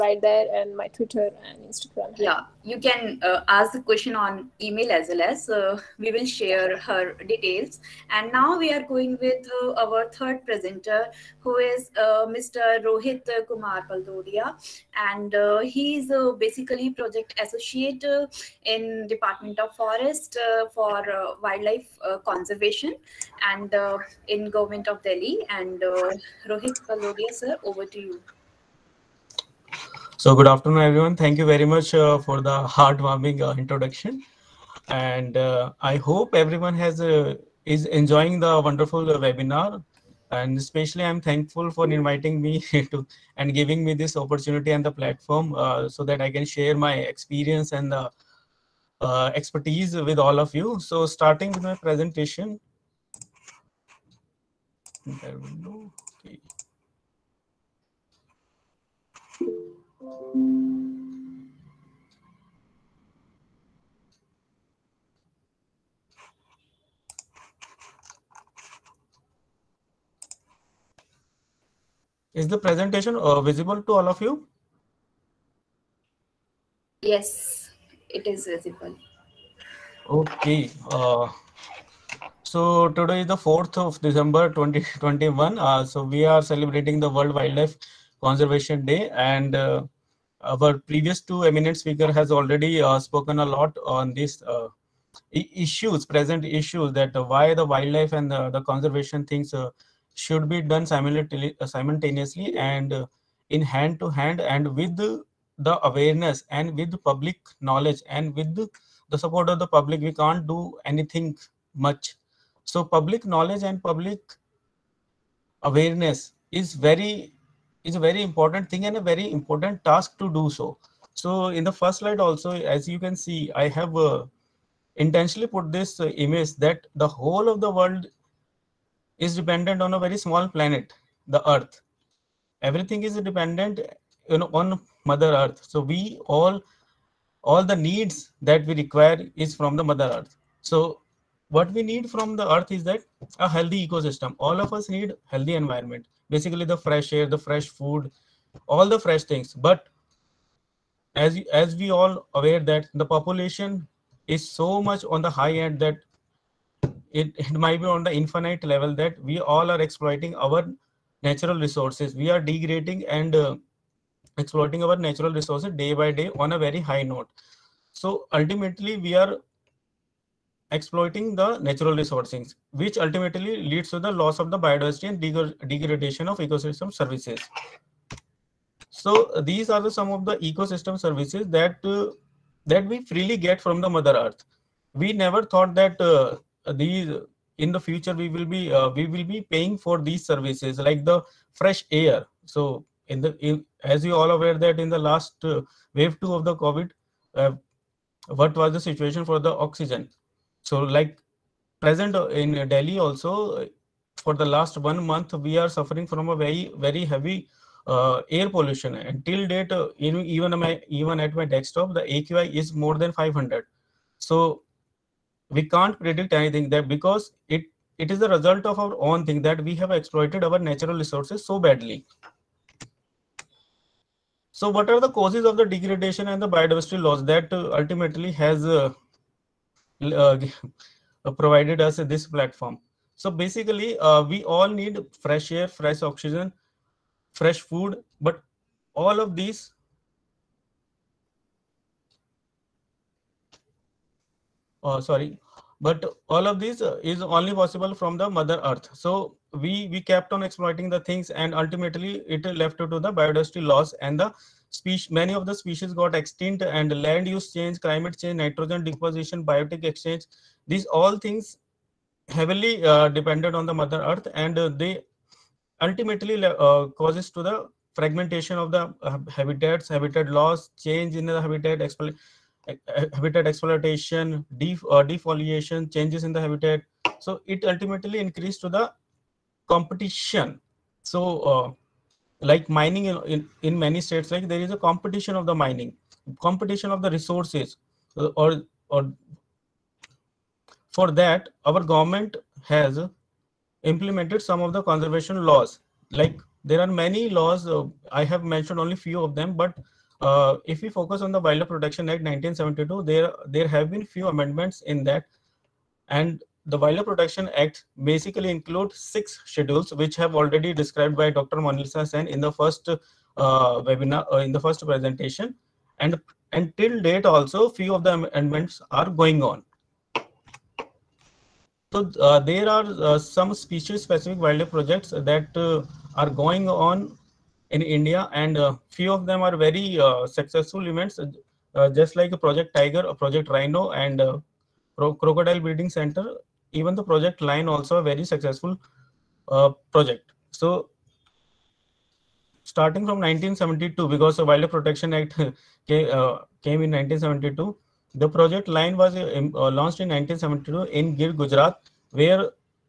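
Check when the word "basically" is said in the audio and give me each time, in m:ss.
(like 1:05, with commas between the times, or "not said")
0:16, 2:26, 3:53, 5:08.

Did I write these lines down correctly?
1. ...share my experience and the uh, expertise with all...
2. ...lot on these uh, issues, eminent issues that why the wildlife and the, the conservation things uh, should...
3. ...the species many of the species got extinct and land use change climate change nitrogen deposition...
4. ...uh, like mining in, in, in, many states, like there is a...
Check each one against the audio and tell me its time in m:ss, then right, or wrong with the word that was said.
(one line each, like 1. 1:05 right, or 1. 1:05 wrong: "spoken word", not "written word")
1. 0:46 right
2. 1:33 wrong: "present", not "eminent"
3. 4:14 right
4. 4:41 right.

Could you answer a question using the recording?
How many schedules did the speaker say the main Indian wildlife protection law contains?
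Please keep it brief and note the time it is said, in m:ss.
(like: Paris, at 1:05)
6, at 5:08.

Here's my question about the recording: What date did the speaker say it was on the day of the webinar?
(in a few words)
4th of December 2021.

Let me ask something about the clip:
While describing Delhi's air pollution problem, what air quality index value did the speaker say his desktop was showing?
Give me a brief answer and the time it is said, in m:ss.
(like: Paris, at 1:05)
More than 500, at 3:32.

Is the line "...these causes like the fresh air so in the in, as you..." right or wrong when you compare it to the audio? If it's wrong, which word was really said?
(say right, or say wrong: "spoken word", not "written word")
wrong: "services", not "causes".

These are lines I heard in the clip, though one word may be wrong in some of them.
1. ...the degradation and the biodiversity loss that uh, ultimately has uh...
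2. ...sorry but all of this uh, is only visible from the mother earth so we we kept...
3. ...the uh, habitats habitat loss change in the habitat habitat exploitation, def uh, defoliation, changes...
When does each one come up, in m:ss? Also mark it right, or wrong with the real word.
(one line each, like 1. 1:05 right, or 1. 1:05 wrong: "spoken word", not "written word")
1. 3:45 right
2. 4:05 wrong: "possible", not "visible"
3. 4:28 right.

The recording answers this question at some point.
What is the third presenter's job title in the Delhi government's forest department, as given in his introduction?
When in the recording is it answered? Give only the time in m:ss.
0:16.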